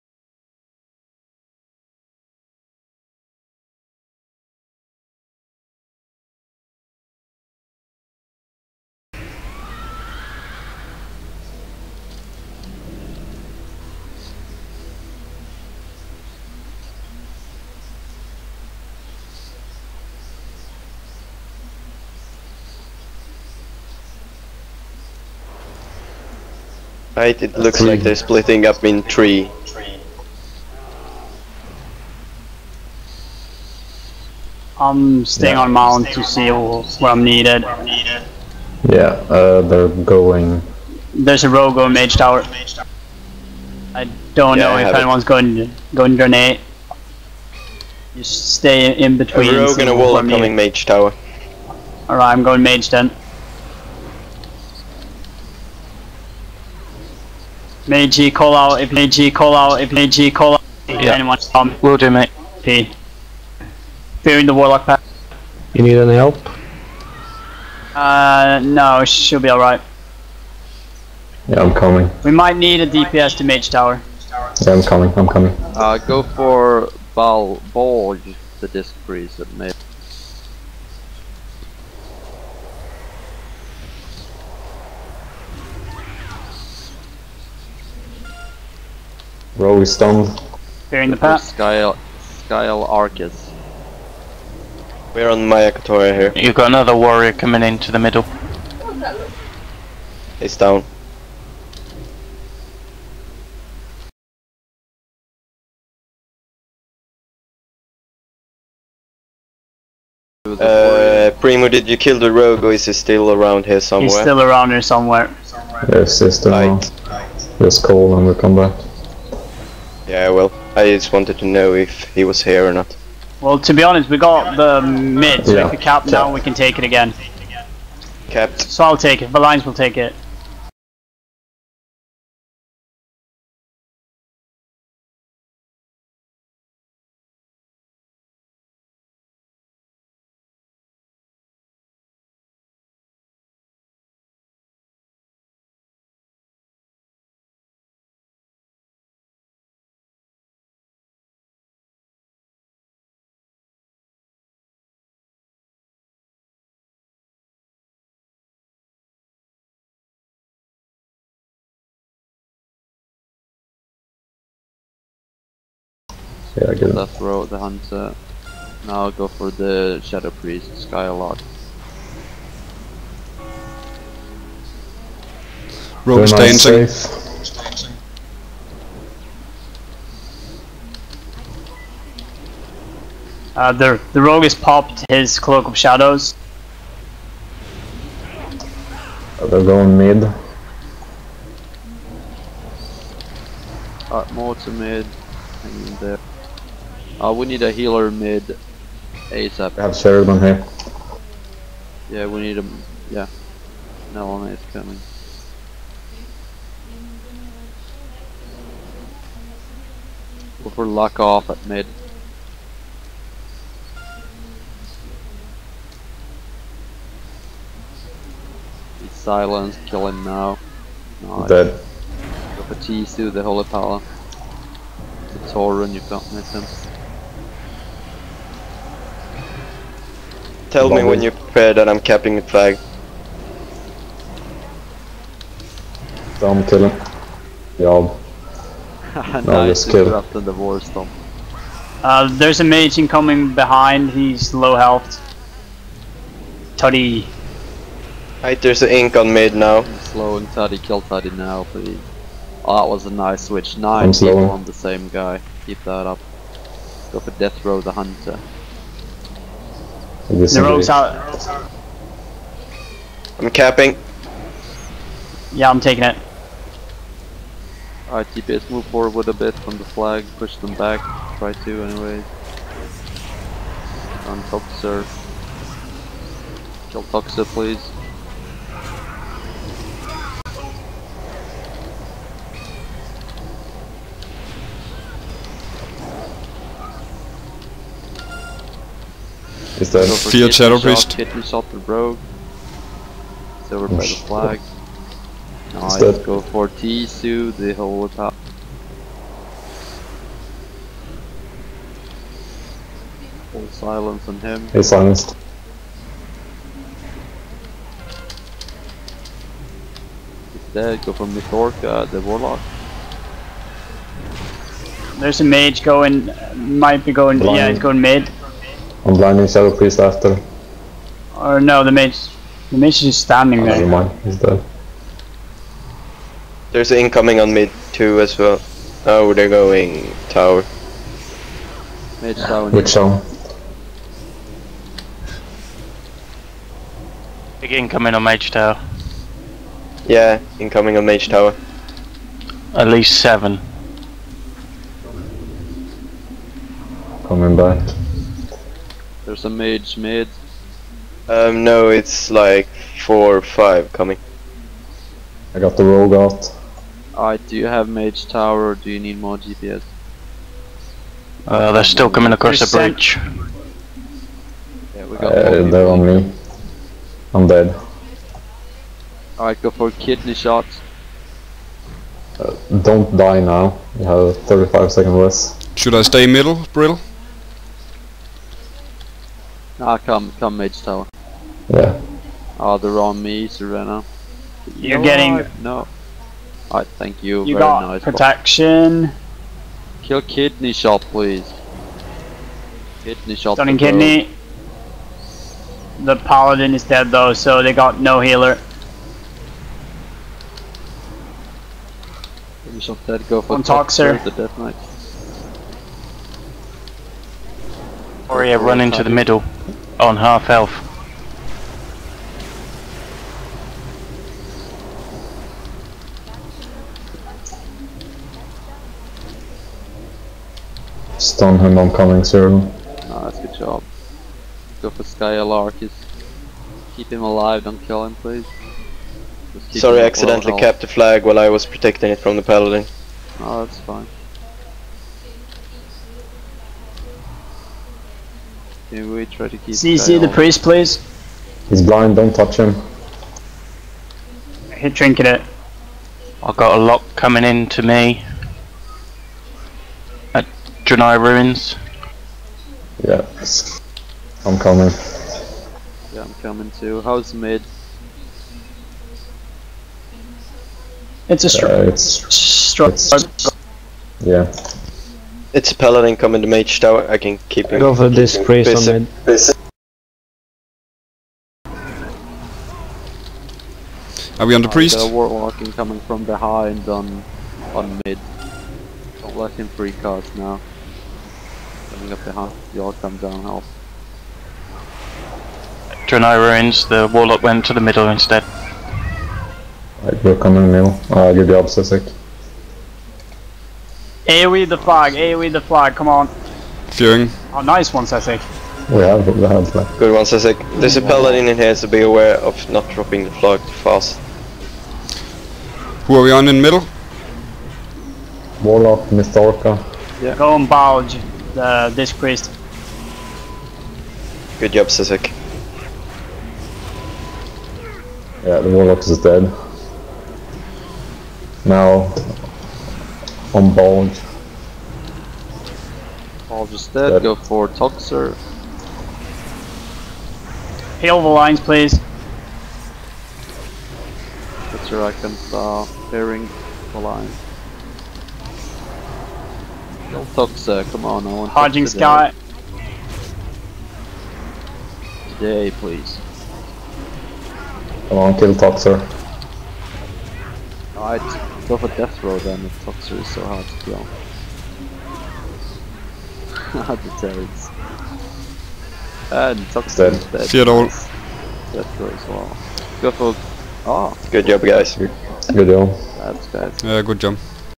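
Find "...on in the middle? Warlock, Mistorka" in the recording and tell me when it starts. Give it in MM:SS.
08:26.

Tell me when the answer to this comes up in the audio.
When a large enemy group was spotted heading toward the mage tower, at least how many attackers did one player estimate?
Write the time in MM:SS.
05:42.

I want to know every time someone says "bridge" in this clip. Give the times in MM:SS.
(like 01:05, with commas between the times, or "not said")
06:02.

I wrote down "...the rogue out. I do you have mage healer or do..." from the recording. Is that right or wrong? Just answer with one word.
wrong.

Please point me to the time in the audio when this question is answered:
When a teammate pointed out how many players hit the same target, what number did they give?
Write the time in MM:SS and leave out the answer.
04:13.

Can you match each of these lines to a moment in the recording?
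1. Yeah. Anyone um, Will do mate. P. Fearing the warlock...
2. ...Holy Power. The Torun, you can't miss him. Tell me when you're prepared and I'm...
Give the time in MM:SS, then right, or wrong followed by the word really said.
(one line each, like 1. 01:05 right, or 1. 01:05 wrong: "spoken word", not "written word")
1. 01:00 right
2. 03:43 right.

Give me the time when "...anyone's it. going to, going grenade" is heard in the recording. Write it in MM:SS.
00:44.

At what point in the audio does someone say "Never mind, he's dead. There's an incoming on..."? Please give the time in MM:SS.
05:23.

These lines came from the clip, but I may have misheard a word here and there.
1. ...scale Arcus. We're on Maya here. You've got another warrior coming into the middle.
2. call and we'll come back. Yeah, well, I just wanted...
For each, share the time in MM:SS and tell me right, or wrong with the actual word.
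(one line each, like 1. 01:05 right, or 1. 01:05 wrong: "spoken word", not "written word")
1. 01:32 right
2. 01:57 right.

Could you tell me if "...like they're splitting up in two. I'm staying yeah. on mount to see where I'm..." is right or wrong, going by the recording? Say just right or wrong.
wrong.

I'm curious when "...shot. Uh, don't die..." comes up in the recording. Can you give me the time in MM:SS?
06:10.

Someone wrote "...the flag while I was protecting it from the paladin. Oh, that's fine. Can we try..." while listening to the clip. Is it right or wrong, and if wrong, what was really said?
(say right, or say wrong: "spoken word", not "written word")
right.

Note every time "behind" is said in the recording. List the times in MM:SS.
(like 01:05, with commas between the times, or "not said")
04:03, 07:56, 08:02.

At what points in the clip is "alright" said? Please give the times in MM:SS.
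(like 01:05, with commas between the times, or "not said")
00:52, 01:09, 03:14, 04:28, 06:09, 06:26.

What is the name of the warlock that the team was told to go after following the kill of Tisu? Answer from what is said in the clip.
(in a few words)
Mithorka.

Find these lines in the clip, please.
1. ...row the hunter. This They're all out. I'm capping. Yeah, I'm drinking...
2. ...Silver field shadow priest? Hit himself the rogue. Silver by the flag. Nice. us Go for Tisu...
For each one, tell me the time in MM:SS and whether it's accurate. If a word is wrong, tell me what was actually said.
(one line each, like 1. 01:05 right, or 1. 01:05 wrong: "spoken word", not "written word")
1. 04:17 wrong: "taking", not "drinking"
2. 04:50 right.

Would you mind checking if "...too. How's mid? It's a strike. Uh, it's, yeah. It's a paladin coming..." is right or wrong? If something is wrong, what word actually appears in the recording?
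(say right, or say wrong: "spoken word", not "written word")
right.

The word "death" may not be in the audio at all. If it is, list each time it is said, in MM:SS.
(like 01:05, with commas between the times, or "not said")
04:17, 06:44, 09:11, 09:20.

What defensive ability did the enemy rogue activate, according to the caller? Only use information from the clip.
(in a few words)
Cloak of Shadows.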